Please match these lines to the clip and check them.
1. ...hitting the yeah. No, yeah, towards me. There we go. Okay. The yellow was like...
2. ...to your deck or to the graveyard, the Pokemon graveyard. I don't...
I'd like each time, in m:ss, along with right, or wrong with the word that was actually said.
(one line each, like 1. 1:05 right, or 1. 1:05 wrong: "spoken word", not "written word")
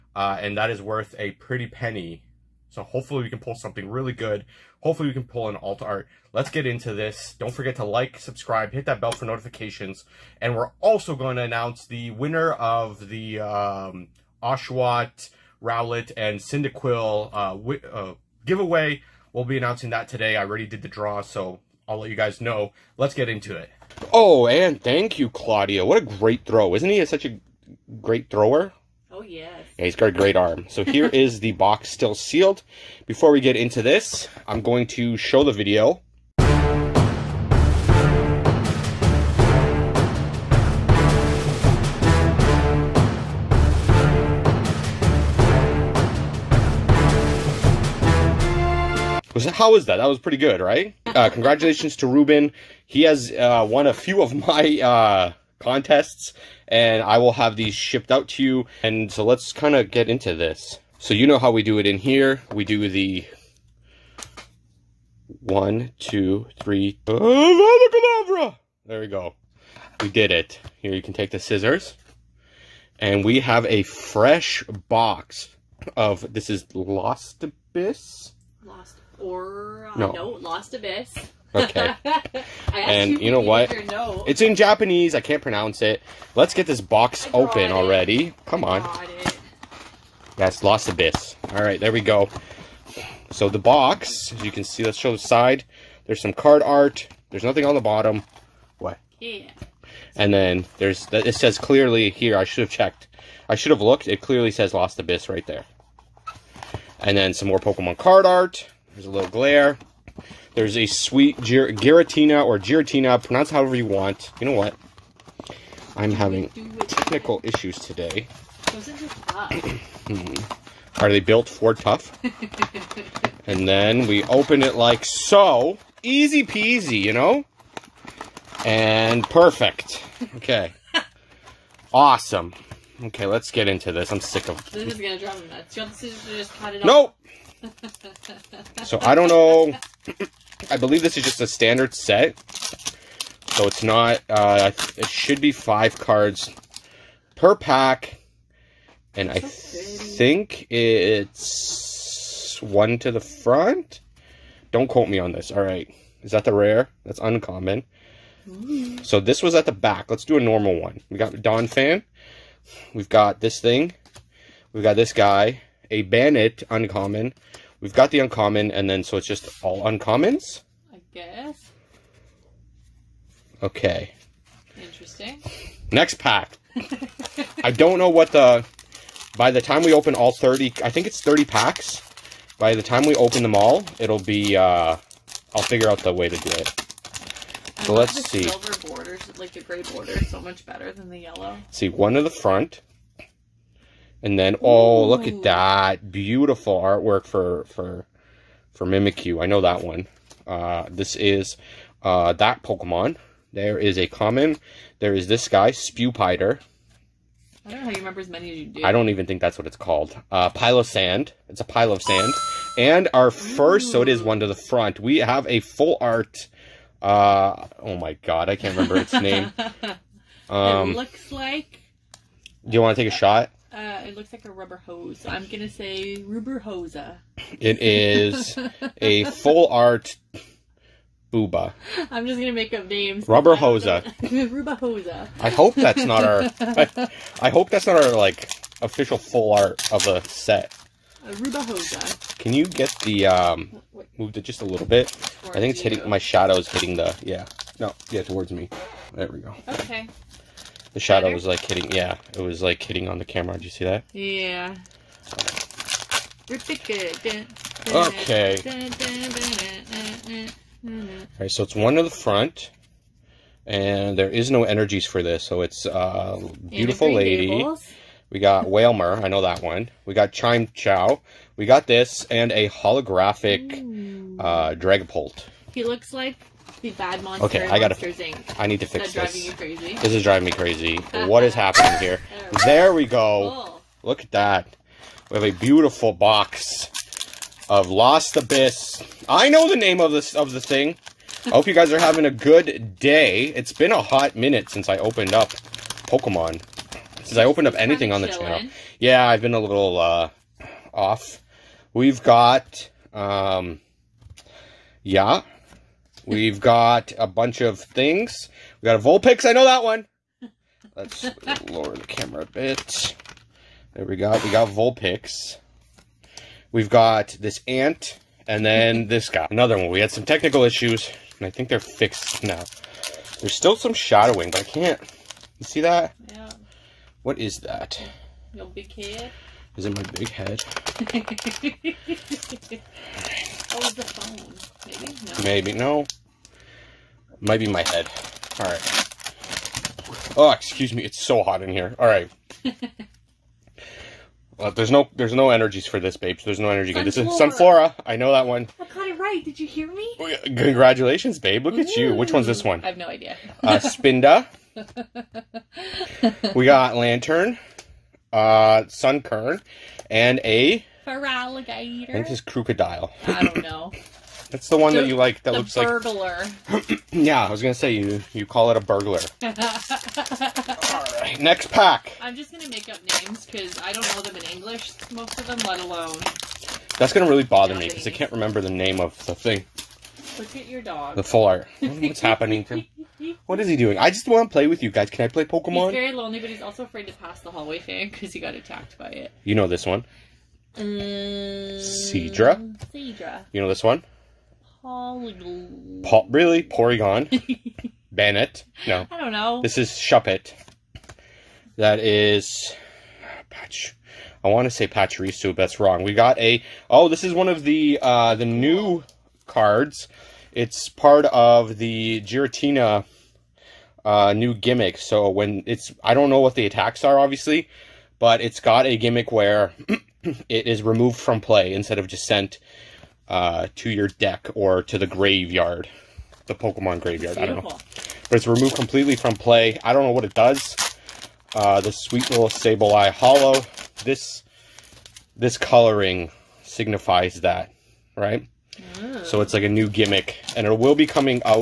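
1. 4:06 wrong: "shadow", not "yellow"
2. 7:03 right.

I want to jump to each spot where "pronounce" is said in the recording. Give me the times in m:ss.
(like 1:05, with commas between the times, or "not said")
1:25, 1:53.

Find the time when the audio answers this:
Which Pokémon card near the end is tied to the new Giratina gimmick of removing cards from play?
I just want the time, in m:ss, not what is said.
7:12.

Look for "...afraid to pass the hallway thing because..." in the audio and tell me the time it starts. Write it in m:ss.
6:26.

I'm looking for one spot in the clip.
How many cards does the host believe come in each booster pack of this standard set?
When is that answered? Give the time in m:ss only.
2:25.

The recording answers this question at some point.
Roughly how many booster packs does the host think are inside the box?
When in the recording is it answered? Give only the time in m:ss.
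3:01.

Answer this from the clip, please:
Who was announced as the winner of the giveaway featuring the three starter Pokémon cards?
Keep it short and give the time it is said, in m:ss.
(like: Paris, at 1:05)
Ruben, at 0:52.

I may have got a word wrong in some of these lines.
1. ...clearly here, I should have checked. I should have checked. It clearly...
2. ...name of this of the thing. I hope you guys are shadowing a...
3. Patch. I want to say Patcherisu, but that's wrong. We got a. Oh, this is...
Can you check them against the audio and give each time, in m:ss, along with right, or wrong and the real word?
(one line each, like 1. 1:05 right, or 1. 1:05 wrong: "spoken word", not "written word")
1. 1:41 wrong: "looked", not "checked"
2. 4:49 wrong: "having", not "shadowing"
3. 6:43 right.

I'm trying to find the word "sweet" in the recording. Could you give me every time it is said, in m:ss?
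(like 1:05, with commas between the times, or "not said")
1:50, 7:11.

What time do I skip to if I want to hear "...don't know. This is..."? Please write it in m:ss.
6:39.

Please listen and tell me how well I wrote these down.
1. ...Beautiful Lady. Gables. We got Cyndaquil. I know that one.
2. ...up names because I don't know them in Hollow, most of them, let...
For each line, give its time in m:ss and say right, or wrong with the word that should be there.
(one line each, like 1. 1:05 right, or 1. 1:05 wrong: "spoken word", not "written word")
1. 4:26 wrong: "Wailmer", not "Cyndaquil"
2. 6:12 wrong: "English", not "Hollow".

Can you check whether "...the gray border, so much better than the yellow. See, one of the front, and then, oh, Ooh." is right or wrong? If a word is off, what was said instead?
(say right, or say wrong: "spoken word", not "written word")
right.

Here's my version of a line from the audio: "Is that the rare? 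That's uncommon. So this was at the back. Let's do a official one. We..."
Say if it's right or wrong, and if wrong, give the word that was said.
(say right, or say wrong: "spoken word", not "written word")
wrong: "normal", not "official".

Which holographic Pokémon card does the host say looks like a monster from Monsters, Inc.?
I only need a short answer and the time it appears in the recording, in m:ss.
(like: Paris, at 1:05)
Dragapult, at 4:34.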